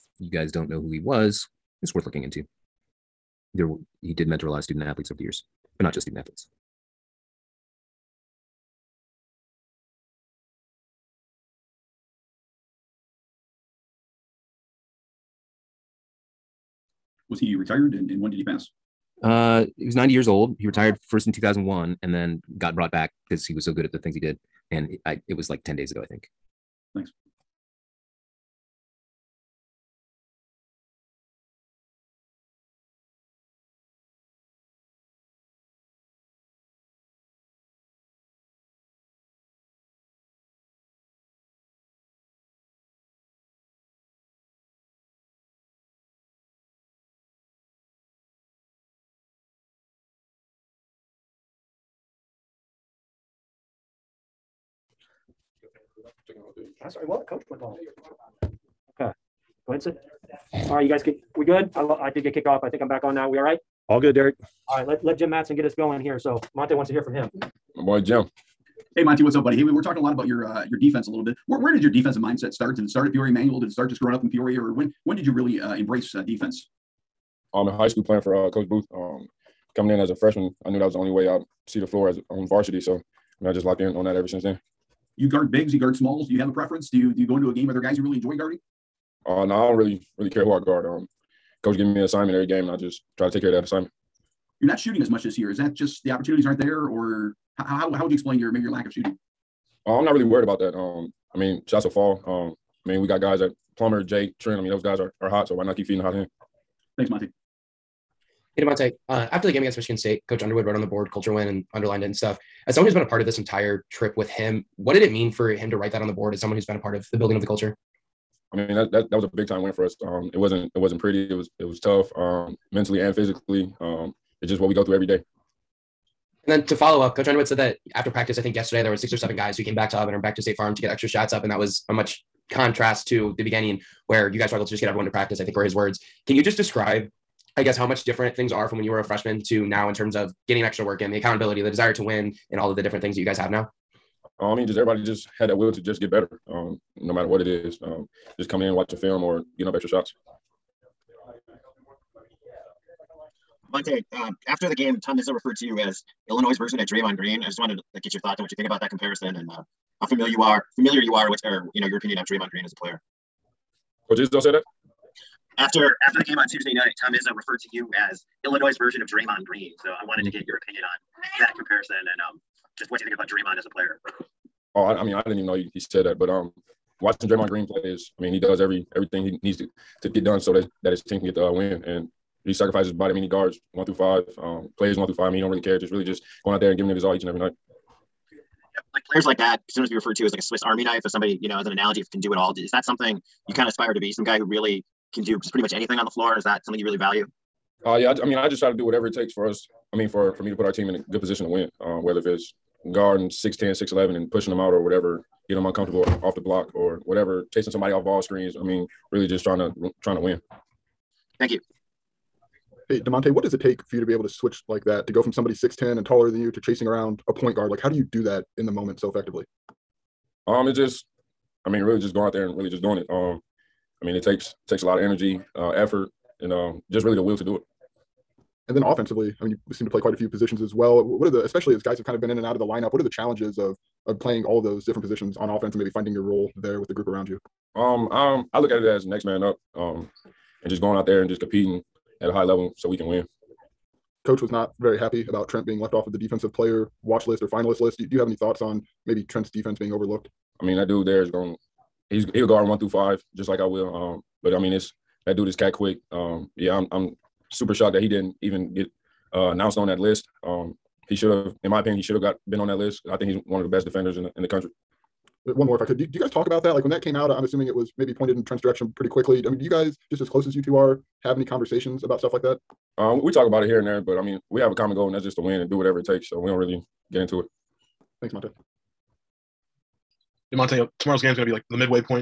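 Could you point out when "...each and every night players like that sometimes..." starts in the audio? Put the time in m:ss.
3:07.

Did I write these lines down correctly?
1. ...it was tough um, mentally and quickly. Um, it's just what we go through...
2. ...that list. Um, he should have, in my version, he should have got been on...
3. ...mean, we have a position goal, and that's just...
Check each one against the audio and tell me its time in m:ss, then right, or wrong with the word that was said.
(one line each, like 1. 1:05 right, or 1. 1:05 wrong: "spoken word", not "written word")
1. 2:01 wrong: "physically", not "quickly"
2. 4:19 wrong: "opinion", not "version"
3. 4:34 wrong: "common", not "position".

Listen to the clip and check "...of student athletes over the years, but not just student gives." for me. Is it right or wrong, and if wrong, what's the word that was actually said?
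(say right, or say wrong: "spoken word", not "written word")
wrong: "athletes", not "gives".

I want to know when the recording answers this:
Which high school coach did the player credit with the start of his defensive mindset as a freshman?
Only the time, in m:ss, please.
1:18.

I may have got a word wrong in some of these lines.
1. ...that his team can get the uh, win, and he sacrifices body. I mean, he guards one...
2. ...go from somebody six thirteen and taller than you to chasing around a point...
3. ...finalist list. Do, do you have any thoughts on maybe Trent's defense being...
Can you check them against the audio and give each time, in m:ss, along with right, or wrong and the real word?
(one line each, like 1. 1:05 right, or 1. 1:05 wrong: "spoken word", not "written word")
1. 3:00 right
2. 3:35 wrong: "ten", not "thirteen"
3. 4:07 right.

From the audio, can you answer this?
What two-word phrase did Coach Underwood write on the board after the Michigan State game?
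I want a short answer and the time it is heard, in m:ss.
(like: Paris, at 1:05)
culture win, at 1:51.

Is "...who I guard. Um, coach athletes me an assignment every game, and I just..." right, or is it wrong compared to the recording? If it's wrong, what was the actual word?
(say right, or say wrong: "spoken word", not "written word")
wrong: "gives", not "athletes".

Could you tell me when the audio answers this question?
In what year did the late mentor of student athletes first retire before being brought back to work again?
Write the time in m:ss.
0:21.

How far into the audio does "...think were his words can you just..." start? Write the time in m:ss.
2:15.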